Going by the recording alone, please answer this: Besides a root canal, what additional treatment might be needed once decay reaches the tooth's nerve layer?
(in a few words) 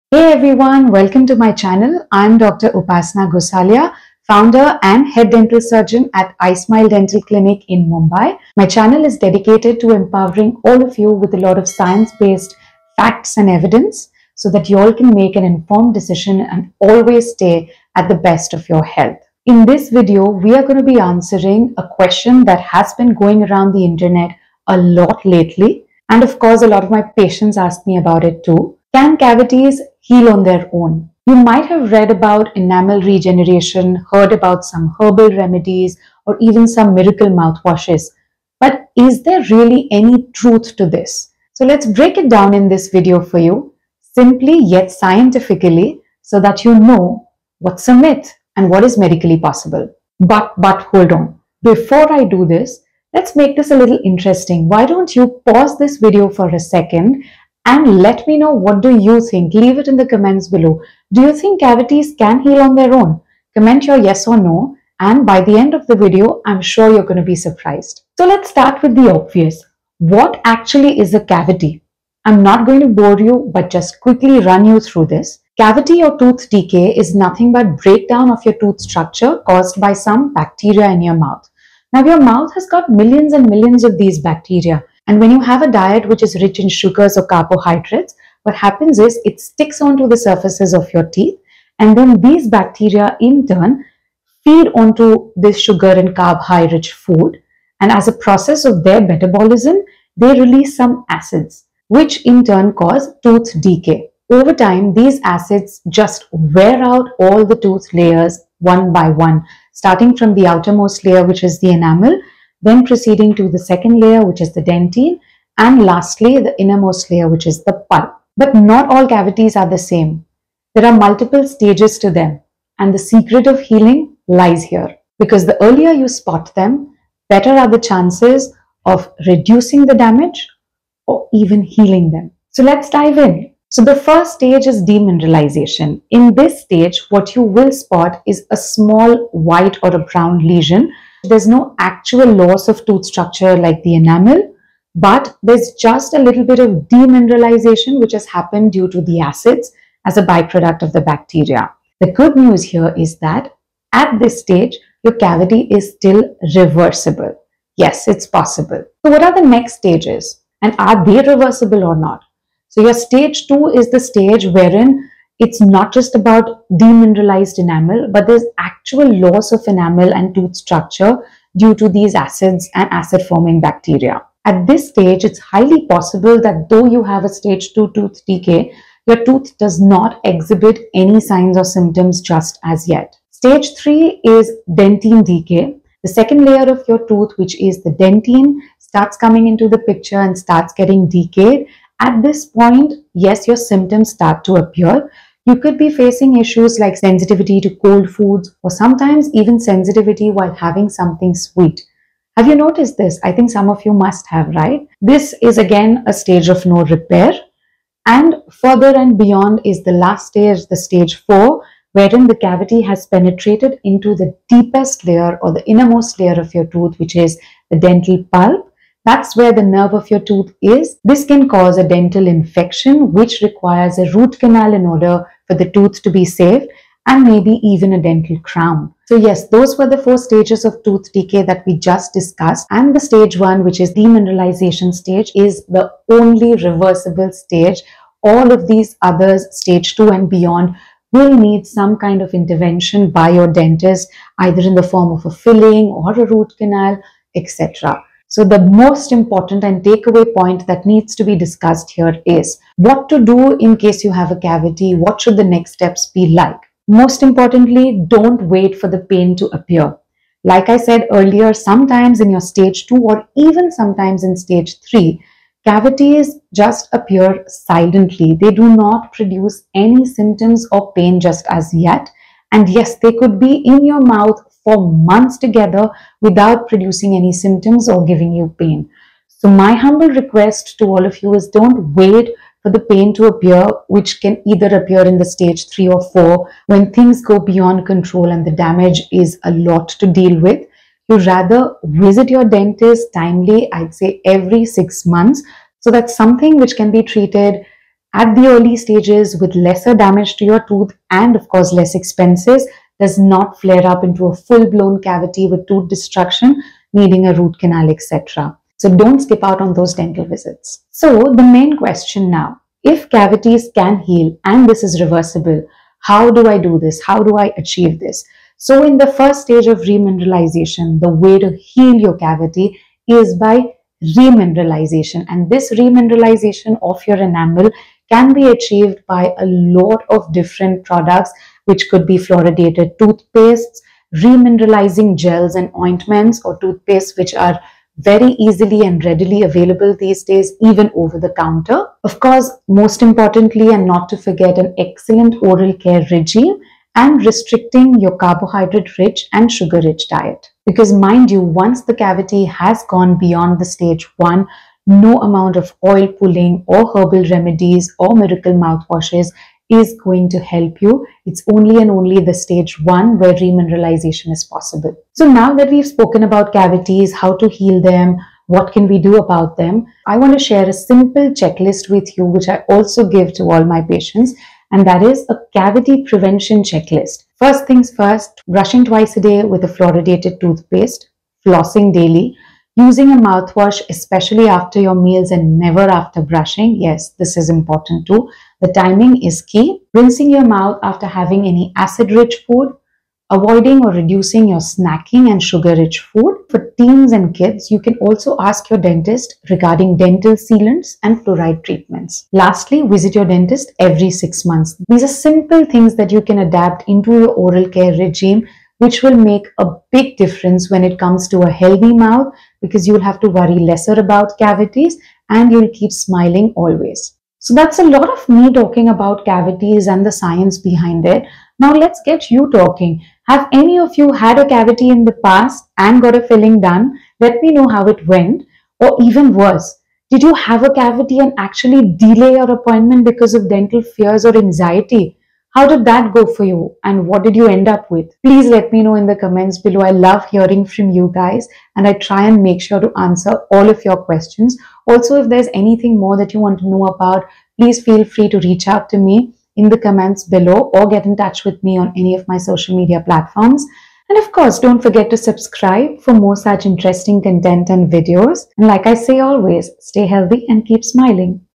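Dental crown.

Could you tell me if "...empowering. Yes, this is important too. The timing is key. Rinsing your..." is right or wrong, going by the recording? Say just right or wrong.
wrong.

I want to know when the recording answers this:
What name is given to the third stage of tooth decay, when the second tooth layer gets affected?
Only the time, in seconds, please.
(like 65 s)
184 s.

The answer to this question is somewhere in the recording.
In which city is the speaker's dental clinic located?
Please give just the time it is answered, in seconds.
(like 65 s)
7 s.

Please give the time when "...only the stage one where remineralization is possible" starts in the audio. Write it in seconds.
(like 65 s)
361 s.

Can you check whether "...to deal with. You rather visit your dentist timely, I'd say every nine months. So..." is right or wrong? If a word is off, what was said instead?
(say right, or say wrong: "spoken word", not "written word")
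wrong: "six", not "nine".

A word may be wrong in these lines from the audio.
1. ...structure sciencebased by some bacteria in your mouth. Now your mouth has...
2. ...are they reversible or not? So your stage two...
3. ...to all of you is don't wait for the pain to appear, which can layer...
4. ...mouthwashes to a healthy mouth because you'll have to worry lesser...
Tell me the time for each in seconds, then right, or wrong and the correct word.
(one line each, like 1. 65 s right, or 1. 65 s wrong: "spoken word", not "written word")
1. 78 s wrong: "caused", not "sciencebased"
2. 160 s right
3. 280 s wrong: "either", not "layer"
4. 410 s wrong: "comes", not "mouthwashes".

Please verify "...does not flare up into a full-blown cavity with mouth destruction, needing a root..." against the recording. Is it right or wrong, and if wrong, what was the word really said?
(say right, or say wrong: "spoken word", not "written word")
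wrong: "tooth", not "mouth".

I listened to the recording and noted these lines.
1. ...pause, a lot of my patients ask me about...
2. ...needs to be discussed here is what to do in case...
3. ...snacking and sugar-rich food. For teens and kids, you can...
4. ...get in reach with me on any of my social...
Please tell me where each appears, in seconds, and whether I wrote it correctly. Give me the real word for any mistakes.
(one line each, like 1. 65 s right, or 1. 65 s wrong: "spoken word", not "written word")
1. 26 s wrong: "course", not "pause"
2. 250 s right
3. 394 s right
4. 450 s wrong: "touch", not "reach".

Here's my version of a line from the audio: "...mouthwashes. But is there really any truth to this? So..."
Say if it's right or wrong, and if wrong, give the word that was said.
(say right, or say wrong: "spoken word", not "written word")
right.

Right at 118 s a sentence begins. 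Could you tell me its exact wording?
But not all cavities are the same.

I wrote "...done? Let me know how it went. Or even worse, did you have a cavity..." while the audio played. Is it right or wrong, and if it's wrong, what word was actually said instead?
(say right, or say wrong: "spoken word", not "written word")
right.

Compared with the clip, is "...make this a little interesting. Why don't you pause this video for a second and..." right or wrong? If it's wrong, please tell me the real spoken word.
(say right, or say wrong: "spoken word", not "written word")
right.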